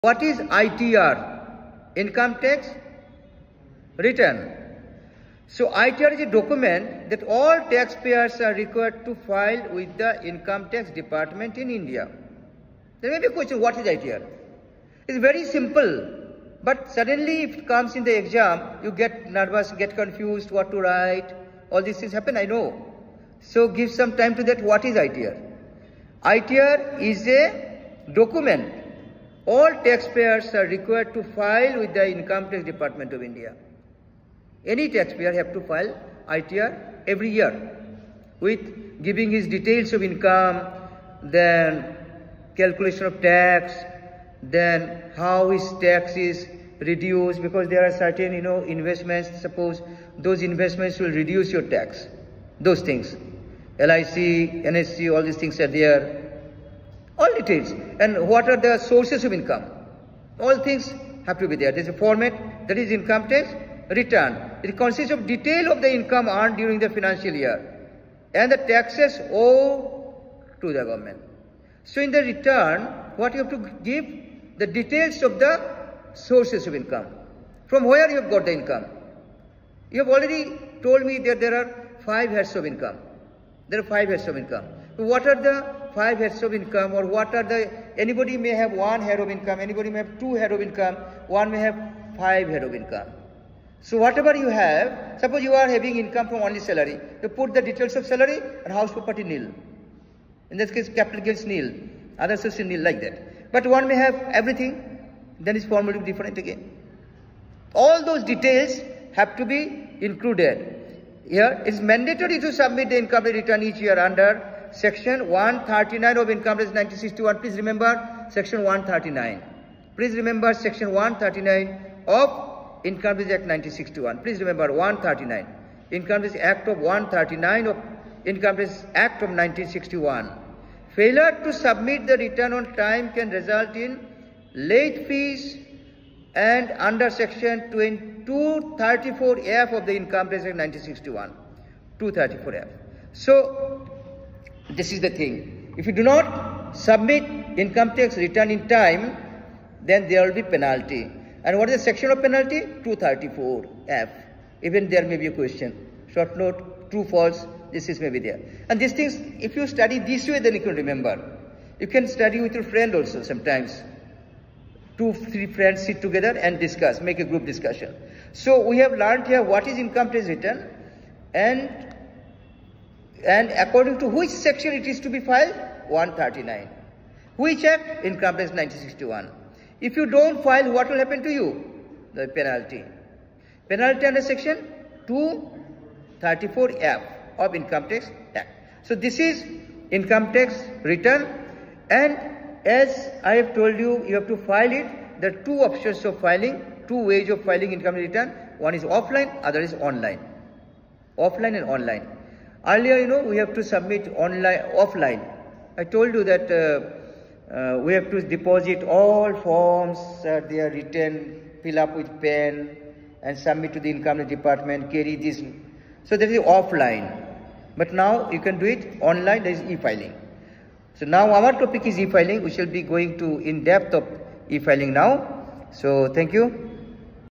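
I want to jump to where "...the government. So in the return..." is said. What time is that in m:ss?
1:10.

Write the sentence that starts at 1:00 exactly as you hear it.
All things have to be there.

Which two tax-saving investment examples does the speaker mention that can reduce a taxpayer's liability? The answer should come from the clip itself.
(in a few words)
LIC, NSC.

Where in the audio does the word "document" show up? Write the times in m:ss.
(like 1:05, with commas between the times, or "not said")
0:06, 0:28.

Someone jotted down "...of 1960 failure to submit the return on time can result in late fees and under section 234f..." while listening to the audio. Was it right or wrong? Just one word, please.
wrong.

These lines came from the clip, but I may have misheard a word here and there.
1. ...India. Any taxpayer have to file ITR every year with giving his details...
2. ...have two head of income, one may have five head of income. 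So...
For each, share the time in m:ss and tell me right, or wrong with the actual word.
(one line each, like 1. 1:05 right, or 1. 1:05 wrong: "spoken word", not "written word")
1. 0:33 right
2. 1:29 right.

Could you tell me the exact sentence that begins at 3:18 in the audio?
One is offline, other is online.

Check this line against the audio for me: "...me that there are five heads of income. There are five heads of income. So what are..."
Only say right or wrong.
right.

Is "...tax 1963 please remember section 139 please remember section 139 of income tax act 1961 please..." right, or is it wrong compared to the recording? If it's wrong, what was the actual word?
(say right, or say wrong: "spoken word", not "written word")
wrong: "1961", not "1963".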